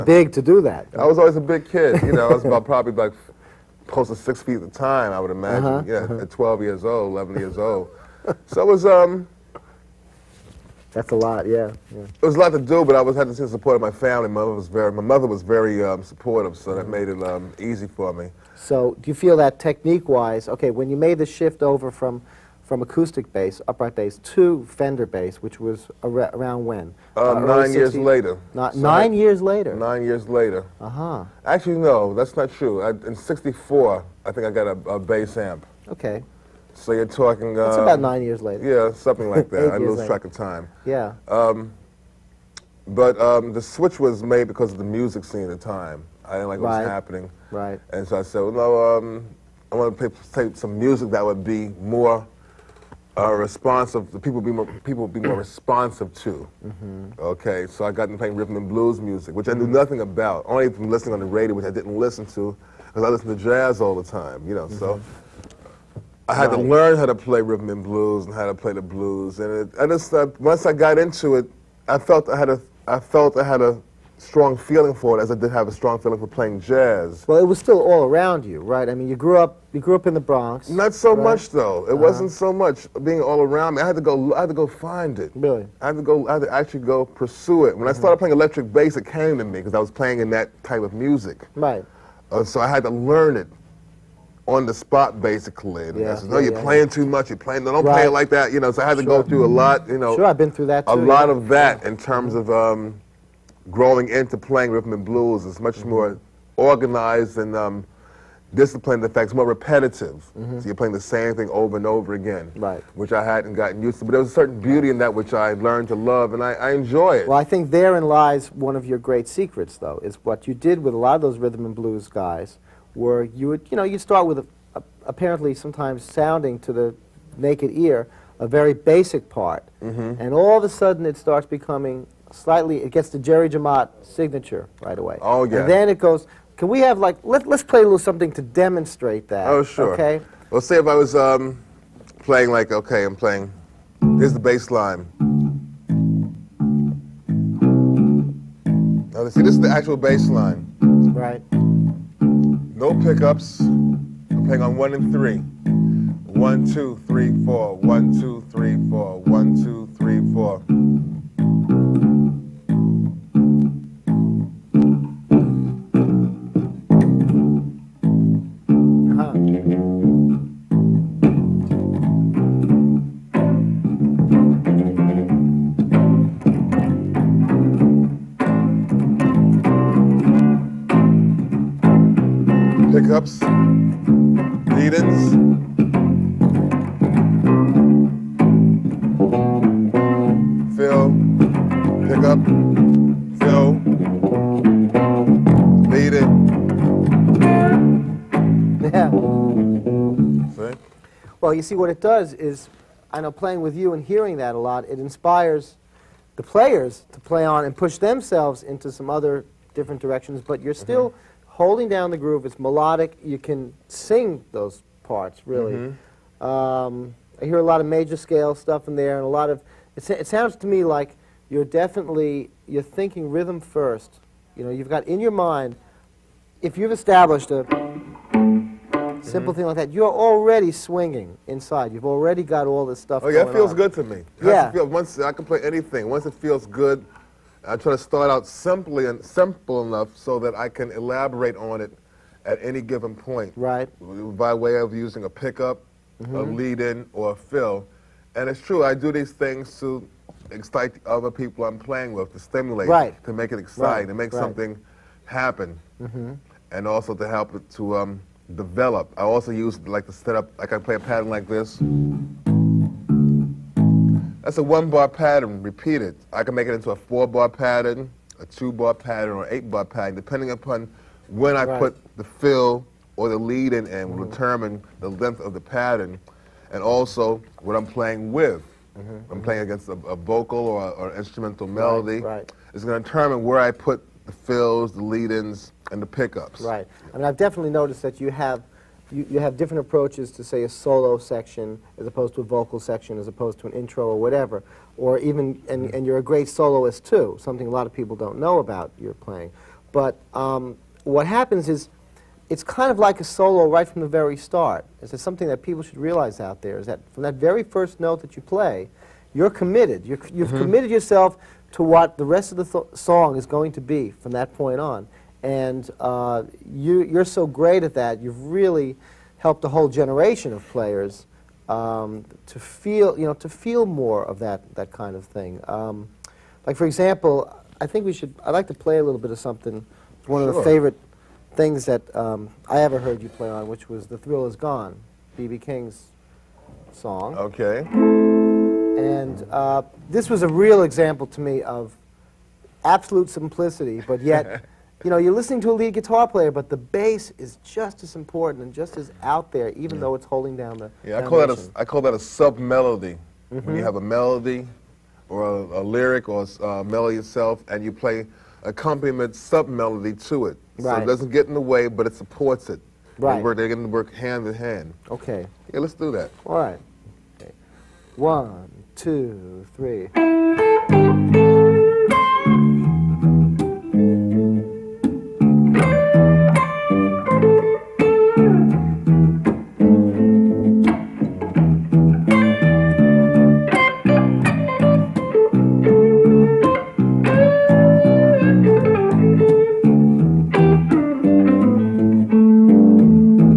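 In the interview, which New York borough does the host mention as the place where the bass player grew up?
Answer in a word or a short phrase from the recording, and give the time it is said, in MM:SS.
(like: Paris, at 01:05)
the Bronx, at 01:20.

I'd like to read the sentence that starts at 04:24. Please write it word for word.
That's a one bar pattern repeated.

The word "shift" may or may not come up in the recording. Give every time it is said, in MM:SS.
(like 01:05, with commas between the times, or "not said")
00:21.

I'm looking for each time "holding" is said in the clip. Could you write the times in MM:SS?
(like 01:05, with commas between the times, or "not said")
03:31, 05:50.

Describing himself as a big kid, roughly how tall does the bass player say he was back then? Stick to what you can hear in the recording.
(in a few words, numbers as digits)
close to 6 feet.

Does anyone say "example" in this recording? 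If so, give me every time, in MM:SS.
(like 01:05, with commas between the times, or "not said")
05:26, 05:40.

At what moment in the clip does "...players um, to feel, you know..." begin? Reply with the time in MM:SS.
05:20.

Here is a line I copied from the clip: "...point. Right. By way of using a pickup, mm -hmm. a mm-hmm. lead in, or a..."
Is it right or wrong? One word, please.
right.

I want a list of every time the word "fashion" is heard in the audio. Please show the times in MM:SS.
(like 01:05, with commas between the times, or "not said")
not said.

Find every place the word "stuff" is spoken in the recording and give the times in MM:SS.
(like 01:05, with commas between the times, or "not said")
03:38, 03:53.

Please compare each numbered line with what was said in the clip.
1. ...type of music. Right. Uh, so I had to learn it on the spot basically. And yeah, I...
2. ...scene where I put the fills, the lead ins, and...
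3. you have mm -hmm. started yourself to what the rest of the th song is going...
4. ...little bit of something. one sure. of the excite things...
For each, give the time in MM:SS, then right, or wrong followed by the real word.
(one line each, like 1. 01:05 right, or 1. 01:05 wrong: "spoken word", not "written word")
1. 01:30 right
2. 04:43 wrong: "determine", not "scene"
3. 05:10 wrong: "committed", not "started"
4. 05:29 wrong: "favorite", not "excite".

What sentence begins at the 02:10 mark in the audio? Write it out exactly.
and all of a sudden it starts becoming slightly, it gets the Jerry Jemmott signature right away.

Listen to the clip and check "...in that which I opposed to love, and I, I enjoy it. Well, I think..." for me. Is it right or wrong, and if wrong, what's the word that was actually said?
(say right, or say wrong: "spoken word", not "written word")
wrong: "learned", not "opposed".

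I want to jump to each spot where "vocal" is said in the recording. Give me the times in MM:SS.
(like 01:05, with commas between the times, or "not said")
04:40, 04:52.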